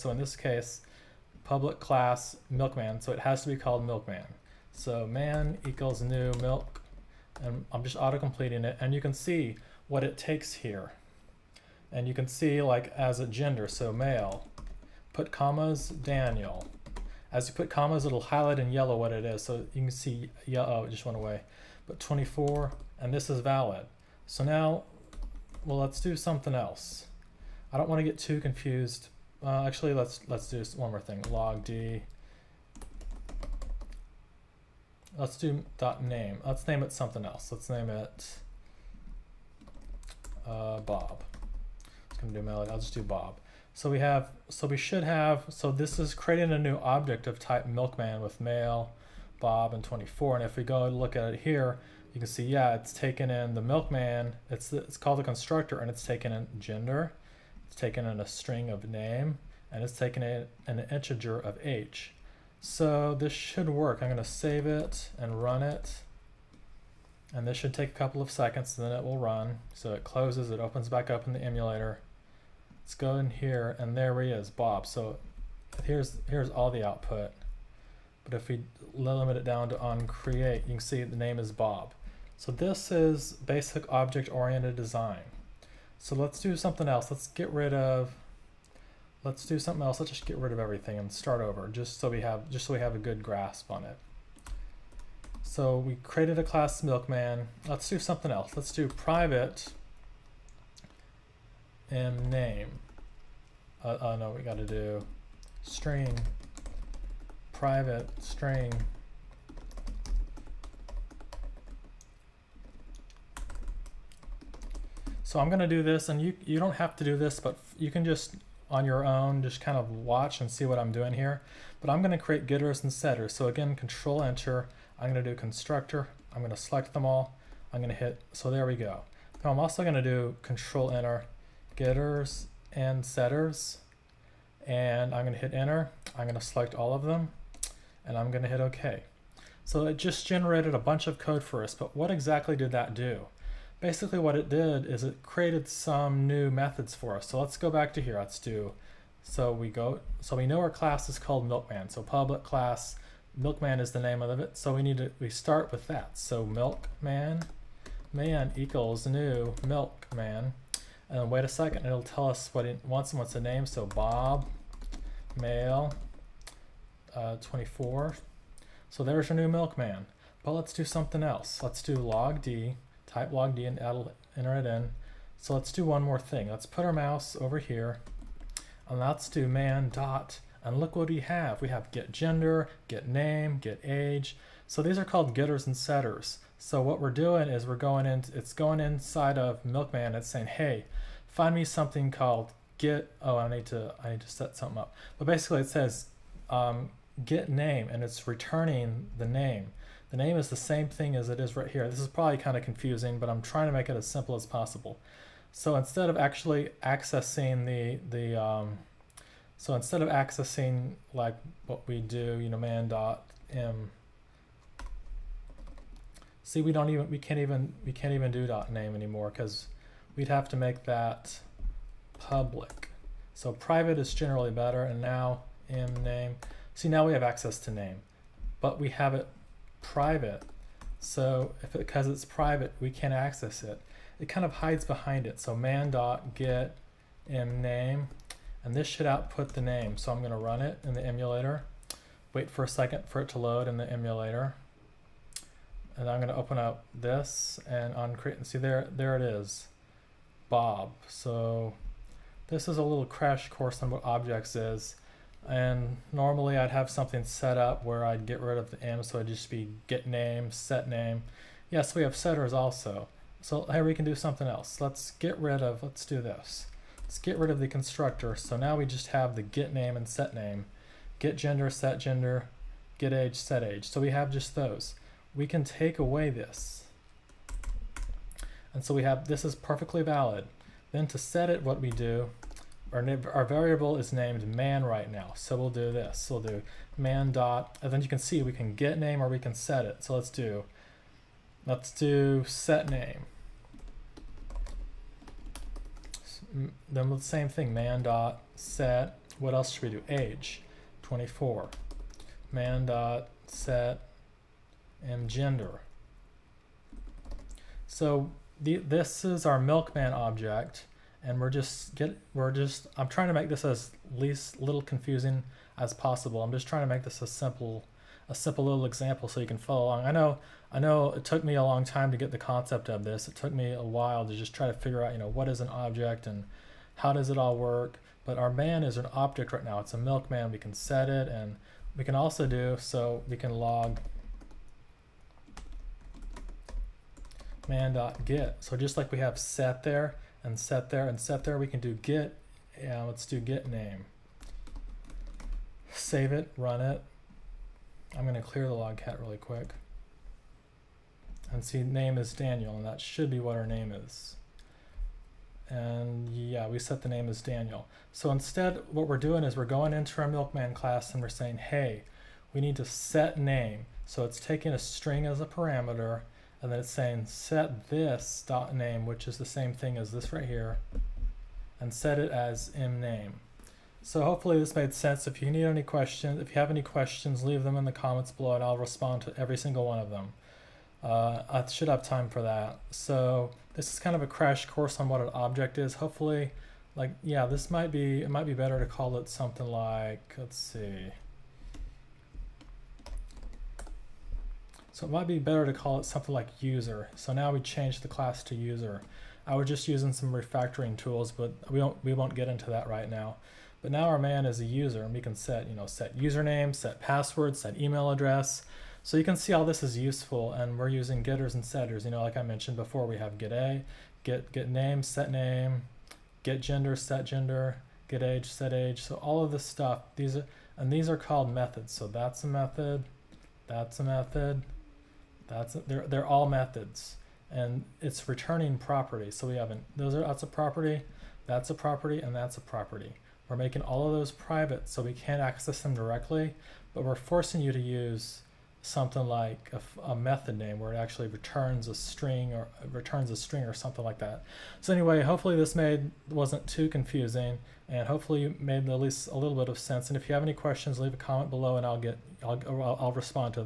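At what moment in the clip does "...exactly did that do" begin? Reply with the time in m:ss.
2:22.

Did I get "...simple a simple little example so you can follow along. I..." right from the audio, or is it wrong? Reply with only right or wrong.
right.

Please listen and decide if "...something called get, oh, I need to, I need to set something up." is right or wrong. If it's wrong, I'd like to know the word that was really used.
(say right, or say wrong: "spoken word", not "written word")
right.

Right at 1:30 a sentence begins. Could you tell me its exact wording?
Let's just get rid of everything and start over just so we have, just so we have a good grasp on it.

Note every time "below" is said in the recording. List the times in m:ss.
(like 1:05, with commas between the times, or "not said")
6:18, 7:31.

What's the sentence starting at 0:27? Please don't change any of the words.
I don't want to get too confused uh, actually, let's let's do one more thing.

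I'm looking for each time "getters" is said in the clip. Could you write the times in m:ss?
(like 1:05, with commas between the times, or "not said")
2:02, 2:11, 3:05, 6:51.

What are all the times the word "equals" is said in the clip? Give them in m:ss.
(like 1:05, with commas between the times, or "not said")
0:05, 2:38.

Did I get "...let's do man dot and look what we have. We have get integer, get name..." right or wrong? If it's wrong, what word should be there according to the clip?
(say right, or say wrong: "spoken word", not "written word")
wrong: "gender", not "integer".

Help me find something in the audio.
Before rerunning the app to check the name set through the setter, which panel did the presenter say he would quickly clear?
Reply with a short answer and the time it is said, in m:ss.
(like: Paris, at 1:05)
logcat, at 5:48.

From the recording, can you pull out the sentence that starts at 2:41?
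And wait a second, it'll tell us what it wants and what's the name.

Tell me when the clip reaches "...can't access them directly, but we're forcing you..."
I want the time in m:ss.
7:15.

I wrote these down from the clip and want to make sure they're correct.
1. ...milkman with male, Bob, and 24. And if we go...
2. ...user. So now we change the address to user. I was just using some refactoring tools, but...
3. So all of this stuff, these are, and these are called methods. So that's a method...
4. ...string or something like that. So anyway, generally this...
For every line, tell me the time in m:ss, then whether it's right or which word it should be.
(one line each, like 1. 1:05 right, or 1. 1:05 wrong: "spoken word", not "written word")
1. 0:47 right
2. 6:36 wrong: "class", not "address"
3. 6:59 right
4. 7:23 wrong: "hopefully", not "generally".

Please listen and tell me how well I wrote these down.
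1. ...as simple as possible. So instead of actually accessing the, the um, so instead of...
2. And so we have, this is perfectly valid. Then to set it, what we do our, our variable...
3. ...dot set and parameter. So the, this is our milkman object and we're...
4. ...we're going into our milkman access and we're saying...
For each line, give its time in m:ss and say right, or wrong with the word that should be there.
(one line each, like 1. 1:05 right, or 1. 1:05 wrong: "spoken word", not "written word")
1. 3:23 right
2. 4:38 right
3. 5:02 wrong: "gender", not "parameter"
4. 5:59 wrong: "class", not "access".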